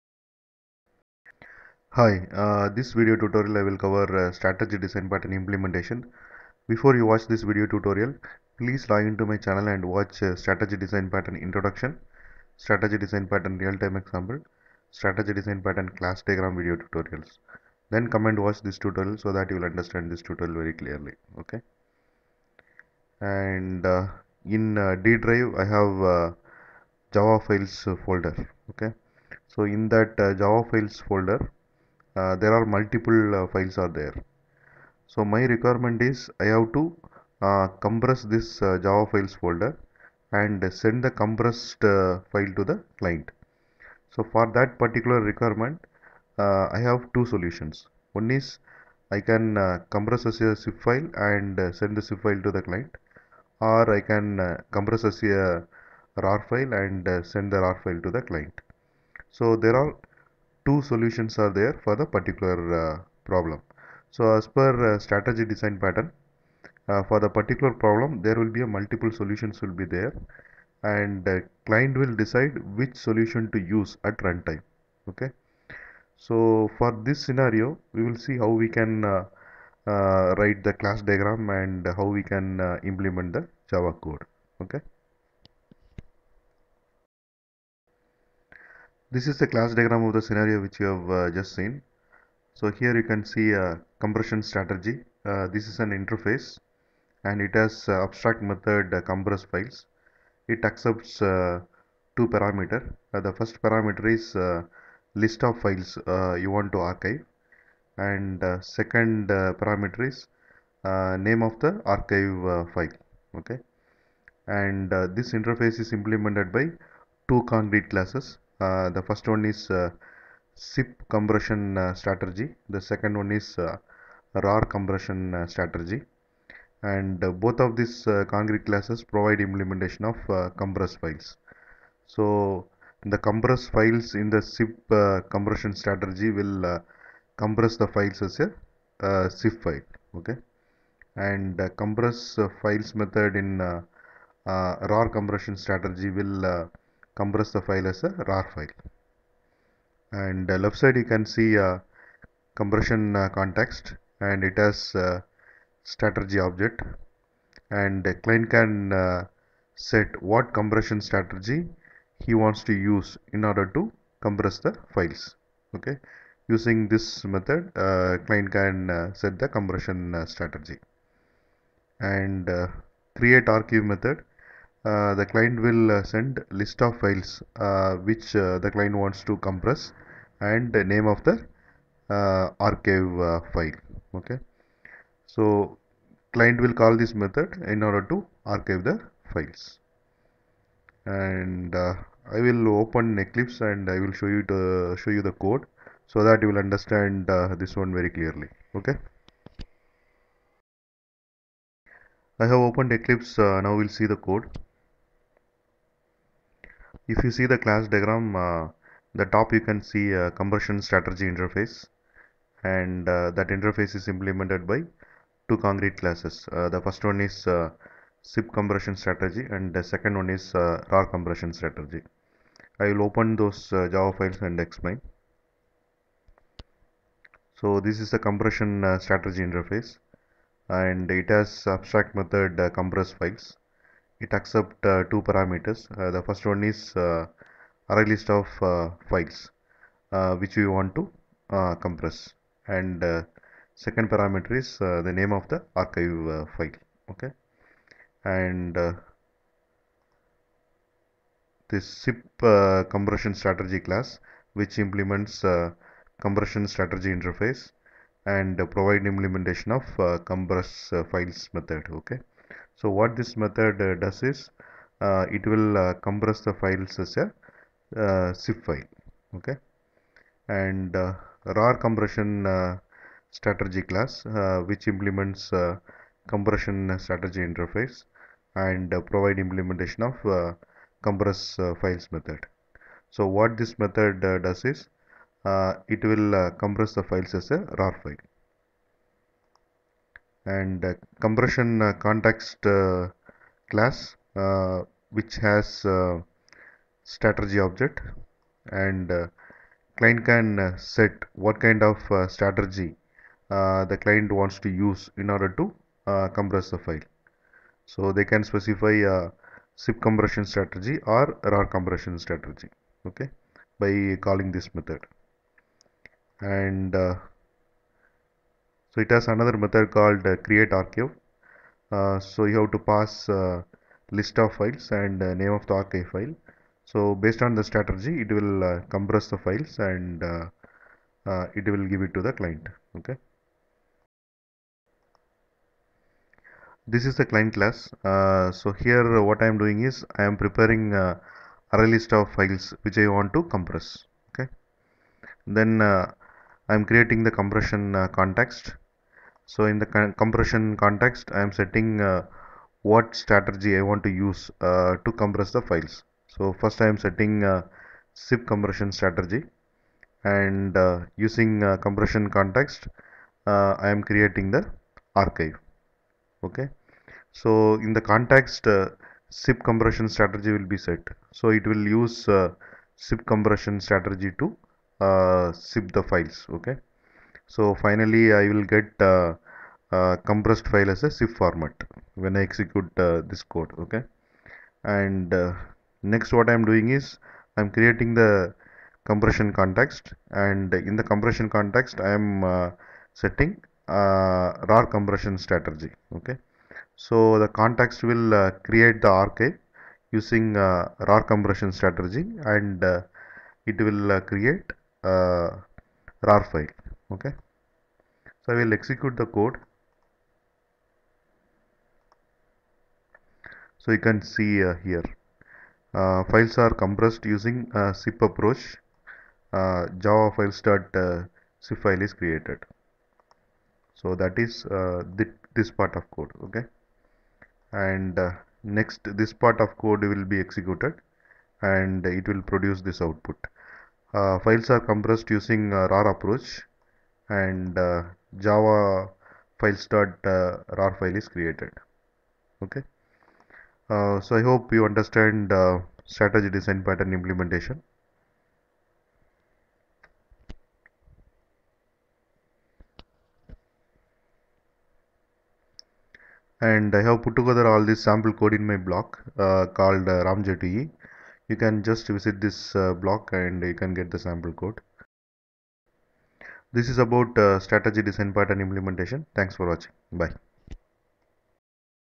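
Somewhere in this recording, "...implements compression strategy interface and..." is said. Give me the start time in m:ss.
4:34.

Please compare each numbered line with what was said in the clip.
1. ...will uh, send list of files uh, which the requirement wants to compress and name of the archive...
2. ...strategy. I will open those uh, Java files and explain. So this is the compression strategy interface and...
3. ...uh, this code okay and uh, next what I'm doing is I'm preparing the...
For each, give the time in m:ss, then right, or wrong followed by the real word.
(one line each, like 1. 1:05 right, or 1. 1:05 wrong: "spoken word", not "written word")
1. 2:55 wrong: "client", not "requirement"
2. 3:41 right
3. 6:23 wrong: "creating", not "preparing".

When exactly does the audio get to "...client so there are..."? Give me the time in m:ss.
0:58.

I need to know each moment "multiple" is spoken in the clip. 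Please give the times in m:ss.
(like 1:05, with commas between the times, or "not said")
0:32, 1:08.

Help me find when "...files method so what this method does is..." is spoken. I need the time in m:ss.
4:41.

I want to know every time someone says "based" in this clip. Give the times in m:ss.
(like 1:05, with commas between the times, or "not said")
5:27.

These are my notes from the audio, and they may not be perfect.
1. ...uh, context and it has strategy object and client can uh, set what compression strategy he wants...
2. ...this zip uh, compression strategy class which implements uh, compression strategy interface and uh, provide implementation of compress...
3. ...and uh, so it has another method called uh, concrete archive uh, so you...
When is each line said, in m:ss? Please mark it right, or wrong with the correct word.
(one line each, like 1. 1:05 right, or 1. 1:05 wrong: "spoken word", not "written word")
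1. 2:33 right
2. 4:11 right
3. 5:16 wrong: "create", not "concrete".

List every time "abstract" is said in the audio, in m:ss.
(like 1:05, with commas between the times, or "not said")
1:38, 3:51.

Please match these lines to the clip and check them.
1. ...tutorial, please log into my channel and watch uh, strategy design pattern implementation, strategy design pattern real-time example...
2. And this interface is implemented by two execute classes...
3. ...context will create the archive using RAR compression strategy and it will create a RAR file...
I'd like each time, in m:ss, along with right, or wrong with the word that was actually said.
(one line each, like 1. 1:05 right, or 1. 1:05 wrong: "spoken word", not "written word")
1. 0:07 wrong: "introduction", not "implementation"
2. 1:54 wrong: "concrete", not "execute"
3. 6:37 right.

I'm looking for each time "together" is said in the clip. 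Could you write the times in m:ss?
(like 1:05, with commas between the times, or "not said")
7:37.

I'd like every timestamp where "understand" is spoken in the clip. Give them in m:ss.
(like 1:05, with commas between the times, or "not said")
0:19, 3:16, 7:24.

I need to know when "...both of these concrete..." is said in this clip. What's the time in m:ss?
2:07.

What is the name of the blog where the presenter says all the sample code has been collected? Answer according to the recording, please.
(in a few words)
ramj2ee.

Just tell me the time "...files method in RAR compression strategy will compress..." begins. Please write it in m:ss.
2:22.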